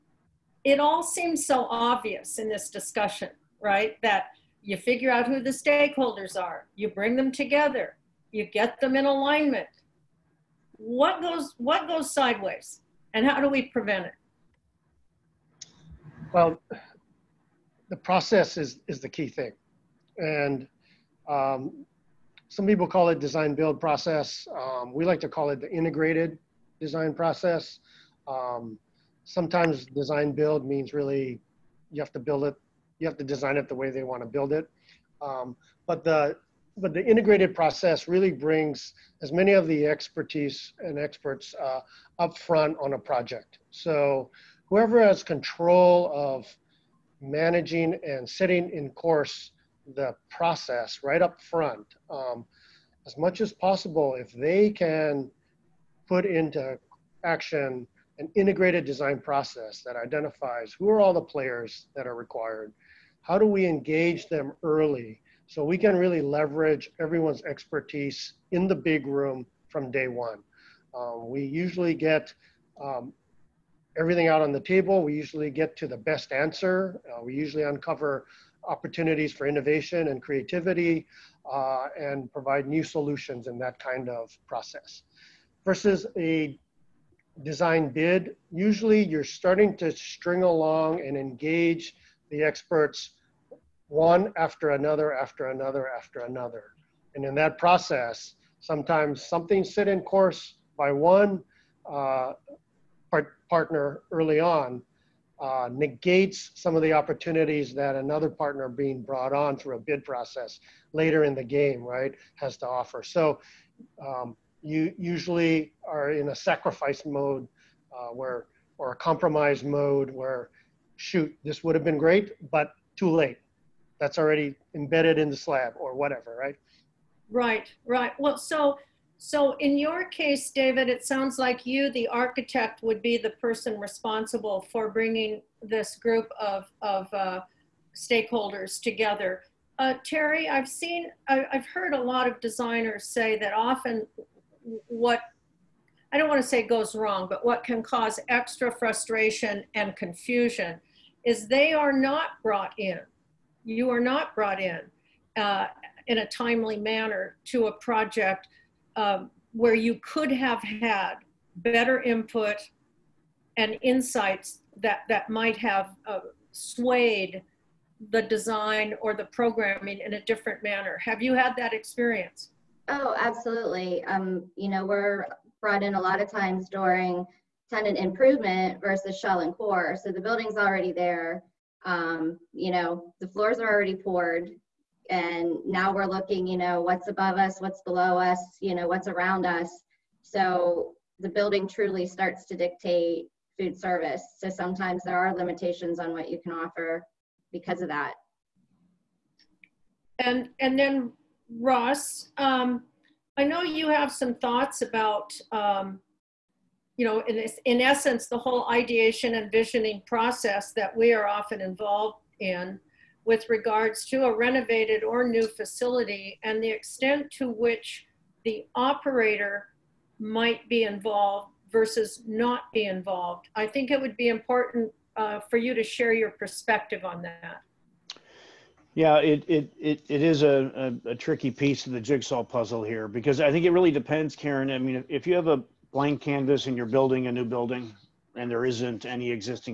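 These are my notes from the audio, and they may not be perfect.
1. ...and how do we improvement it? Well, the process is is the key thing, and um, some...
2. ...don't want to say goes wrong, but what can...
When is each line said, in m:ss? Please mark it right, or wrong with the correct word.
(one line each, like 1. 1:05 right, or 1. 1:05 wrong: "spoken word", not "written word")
1. 0:13 wrong: "prevent", not "improvement"
2. 2:26 right.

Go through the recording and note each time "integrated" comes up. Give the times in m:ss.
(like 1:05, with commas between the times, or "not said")
0:25, 0:37, 0:58.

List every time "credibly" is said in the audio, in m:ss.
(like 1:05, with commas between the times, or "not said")
not said.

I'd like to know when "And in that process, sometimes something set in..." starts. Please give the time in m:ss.
1:37.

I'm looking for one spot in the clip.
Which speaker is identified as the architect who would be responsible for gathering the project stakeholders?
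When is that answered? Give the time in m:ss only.
2:10.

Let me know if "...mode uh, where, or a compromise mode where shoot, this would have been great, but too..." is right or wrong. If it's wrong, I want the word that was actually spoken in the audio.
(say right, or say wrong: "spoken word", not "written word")
right.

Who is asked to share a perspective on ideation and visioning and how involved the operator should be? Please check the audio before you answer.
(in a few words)
Ross.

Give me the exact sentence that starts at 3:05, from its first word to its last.
And now we're looking, you know, what's above us, what's below us, you know, what's around us.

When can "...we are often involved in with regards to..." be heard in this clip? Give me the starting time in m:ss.
3:30.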